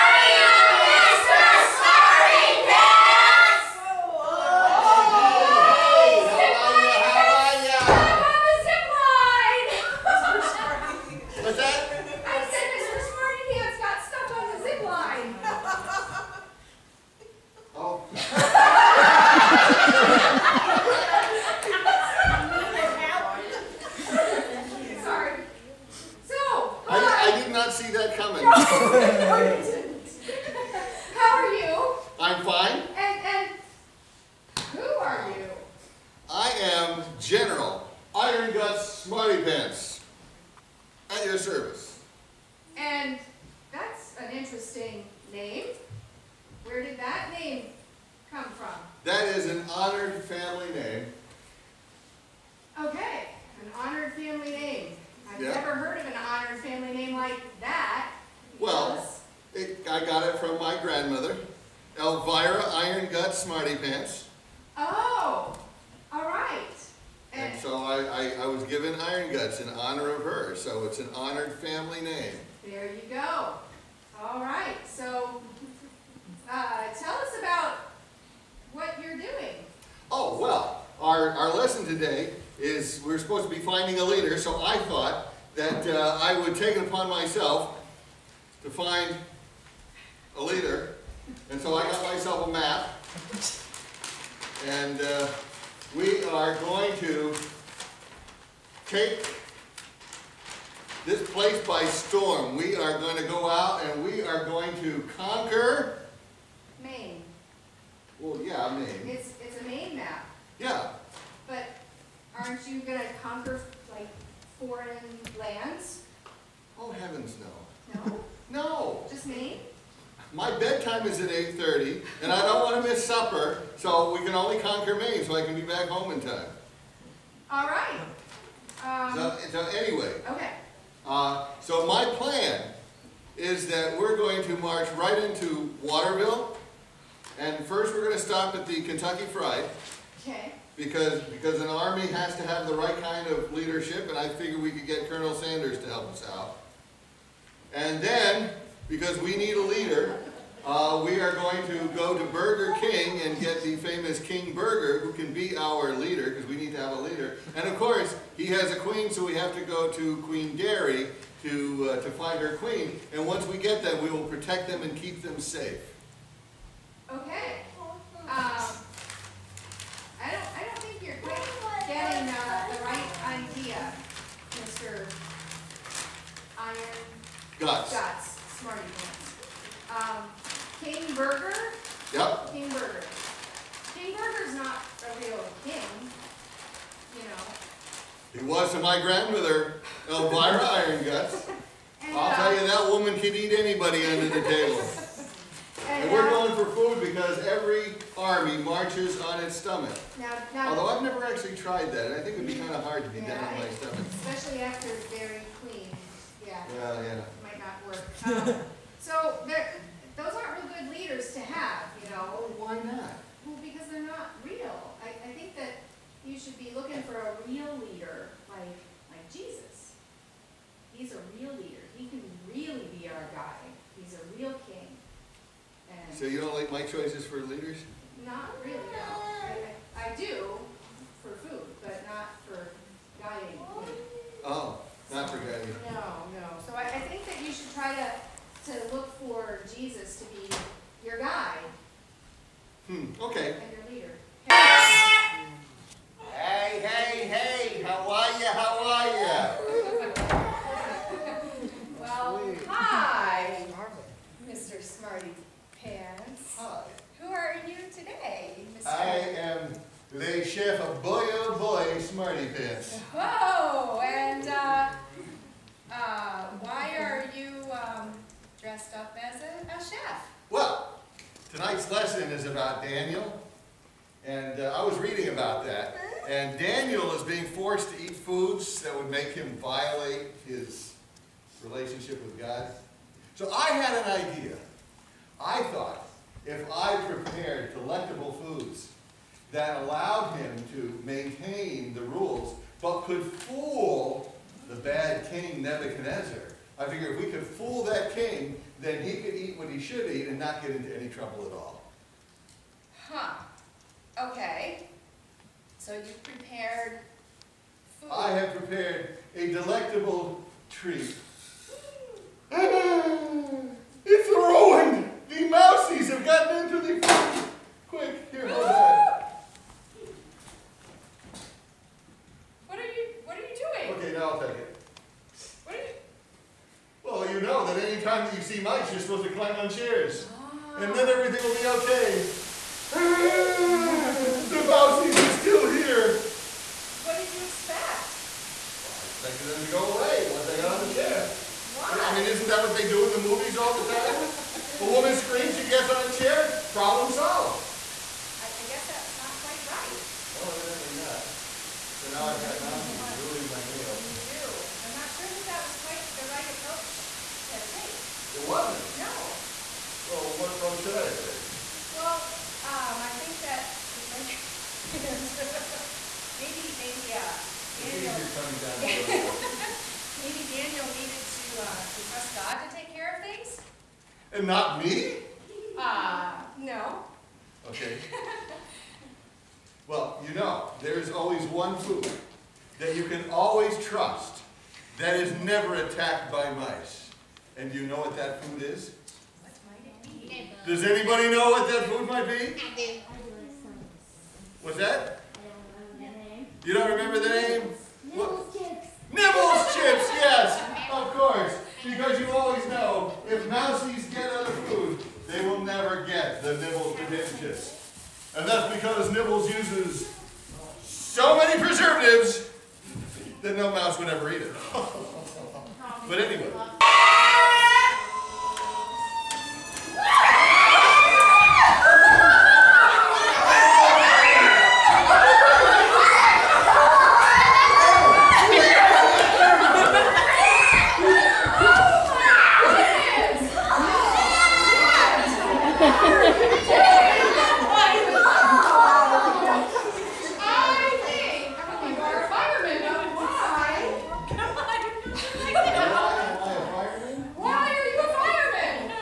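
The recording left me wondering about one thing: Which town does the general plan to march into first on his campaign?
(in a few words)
Waterville.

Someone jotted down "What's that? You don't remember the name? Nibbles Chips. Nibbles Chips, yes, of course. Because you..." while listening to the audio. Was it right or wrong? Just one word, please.
right.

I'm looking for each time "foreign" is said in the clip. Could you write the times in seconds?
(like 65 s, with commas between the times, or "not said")
114 s.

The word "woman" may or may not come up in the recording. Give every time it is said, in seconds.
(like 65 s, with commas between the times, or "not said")
344 s.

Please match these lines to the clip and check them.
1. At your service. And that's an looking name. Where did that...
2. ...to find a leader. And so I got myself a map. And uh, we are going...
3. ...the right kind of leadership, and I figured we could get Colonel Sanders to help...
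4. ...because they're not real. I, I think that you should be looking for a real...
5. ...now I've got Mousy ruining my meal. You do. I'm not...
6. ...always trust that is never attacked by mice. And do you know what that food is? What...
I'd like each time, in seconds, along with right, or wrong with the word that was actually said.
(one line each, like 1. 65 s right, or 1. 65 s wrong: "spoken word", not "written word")
1. 41 s wrong: "interesting", not "looking"
2. 88 s right
3. 142 s right
4. 213 s right
5. 352 s right
6. 383 s right.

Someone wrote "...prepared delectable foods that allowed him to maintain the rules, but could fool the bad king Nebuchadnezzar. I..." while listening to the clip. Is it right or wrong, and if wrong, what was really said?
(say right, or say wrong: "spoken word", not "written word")
right.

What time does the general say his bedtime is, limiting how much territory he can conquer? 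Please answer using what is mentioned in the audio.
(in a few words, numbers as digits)
8:30.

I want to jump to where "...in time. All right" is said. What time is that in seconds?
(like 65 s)
126 s.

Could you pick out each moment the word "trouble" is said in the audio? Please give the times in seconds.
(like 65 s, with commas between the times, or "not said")
301 s.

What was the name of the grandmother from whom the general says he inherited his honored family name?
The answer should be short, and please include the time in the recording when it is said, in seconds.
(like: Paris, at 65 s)
Elvira Iron Gut Smarty Pants, at 61 s.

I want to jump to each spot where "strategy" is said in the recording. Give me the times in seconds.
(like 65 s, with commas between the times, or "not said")
not said.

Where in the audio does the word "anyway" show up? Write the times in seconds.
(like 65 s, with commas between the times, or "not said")
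129 s, 416 s.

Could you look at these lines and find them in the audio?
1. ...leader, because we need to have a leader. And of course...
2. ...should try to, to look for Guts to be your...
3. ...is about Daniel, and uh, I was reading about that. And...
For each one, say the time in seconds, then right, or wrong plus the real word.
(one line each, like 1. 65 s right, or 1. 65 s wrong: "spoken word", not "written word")
1. 155 s right
2. 237 s wrong: "Jesus", not "Guts"
3. 272 s right.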